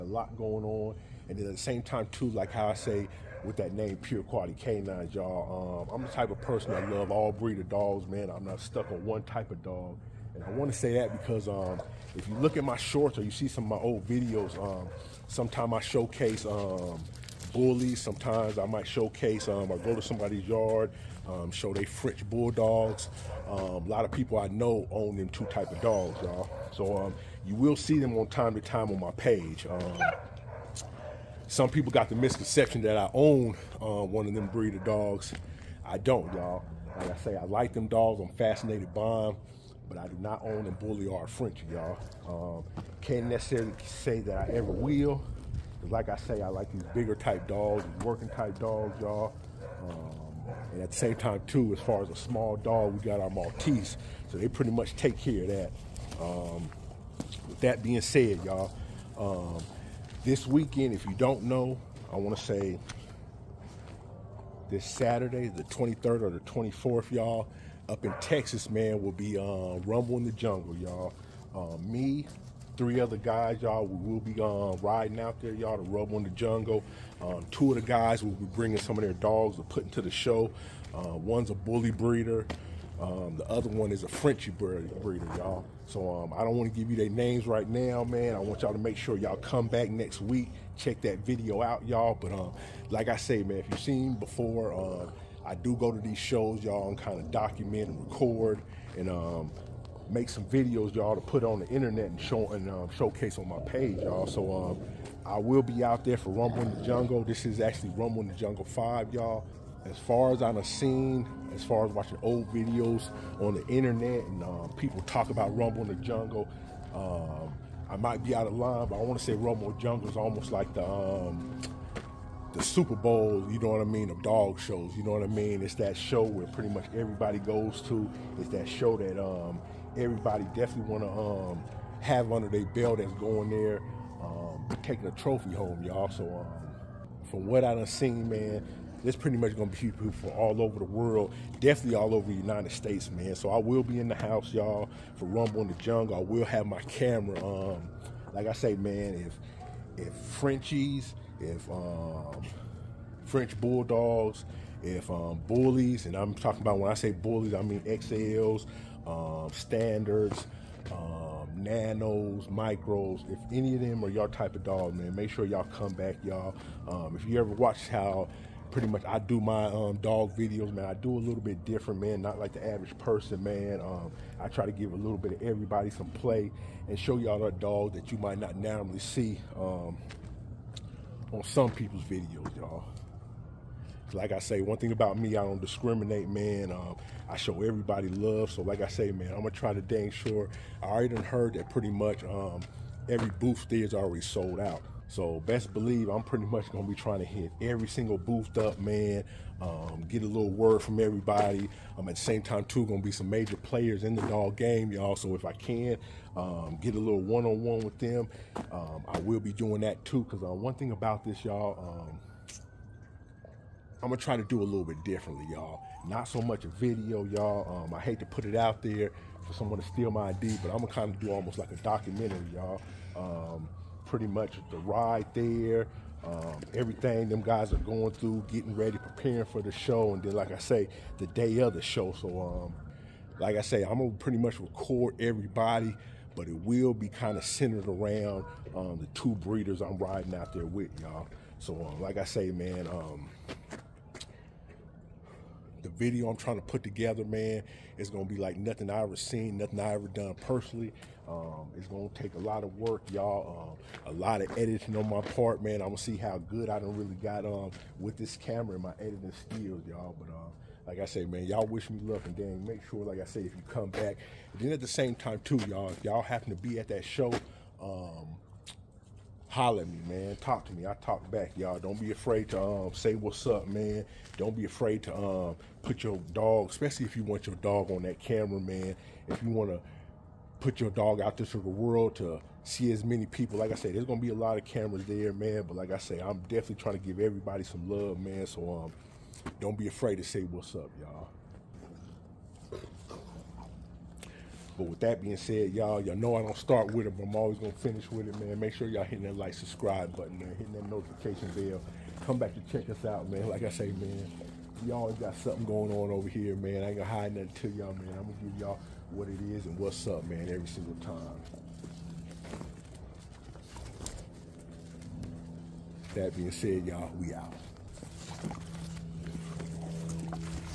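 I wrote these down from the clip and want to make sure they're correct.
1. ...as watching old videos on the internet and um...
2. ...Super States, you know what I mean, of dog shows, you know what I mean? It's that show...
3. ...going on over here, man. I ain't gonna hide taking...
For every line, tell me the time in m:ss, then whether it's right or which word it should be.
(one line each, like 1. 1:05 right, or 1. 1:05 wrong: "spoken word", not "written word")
1. 1:51 right
2. 2:02 wrong: "Bowl", not "States"
3. 5:05 wrong: "nothing", not "taking".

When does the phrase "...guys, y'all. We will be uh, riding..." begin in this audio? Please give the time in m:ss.
1:13.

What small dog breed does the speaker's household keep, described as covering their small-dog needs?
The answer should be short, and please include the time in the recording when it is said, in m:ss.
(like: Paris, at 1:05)
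Maltese, at 0:53.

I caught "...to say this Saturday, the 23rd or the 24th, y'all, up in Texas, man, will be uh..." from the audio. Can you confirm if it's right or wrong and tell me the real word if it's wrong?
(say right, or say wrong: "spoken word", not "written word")
right.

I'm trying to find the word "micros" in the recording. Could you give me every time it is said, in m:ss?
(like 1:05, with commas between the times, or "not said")
2:42.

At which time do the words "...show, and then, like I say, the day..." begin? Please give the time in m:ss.
3:49.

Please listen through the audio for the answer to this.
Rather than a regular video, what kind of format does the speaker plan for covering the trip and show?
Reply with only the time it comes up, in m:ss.
3:41.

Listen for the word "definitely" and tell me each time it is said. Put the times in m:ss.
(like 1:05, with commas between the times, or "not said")
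2:10, 2:21, 4:46.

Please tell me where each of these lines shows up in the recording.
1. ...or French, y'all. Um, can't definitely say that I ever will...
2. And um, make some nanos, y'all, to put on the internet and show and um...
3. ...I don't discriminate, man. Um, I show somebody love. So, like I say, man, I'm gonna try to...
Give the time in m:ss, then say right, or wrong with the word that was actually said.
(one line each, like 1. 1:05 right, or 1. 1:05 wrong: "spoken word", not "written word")
1. 0:41 wrong: "necessarily", not "definitely"
2. 1:38 wrong: "videos", not "nanos"
3. 3:05 wrong: "everybody", not "somebody".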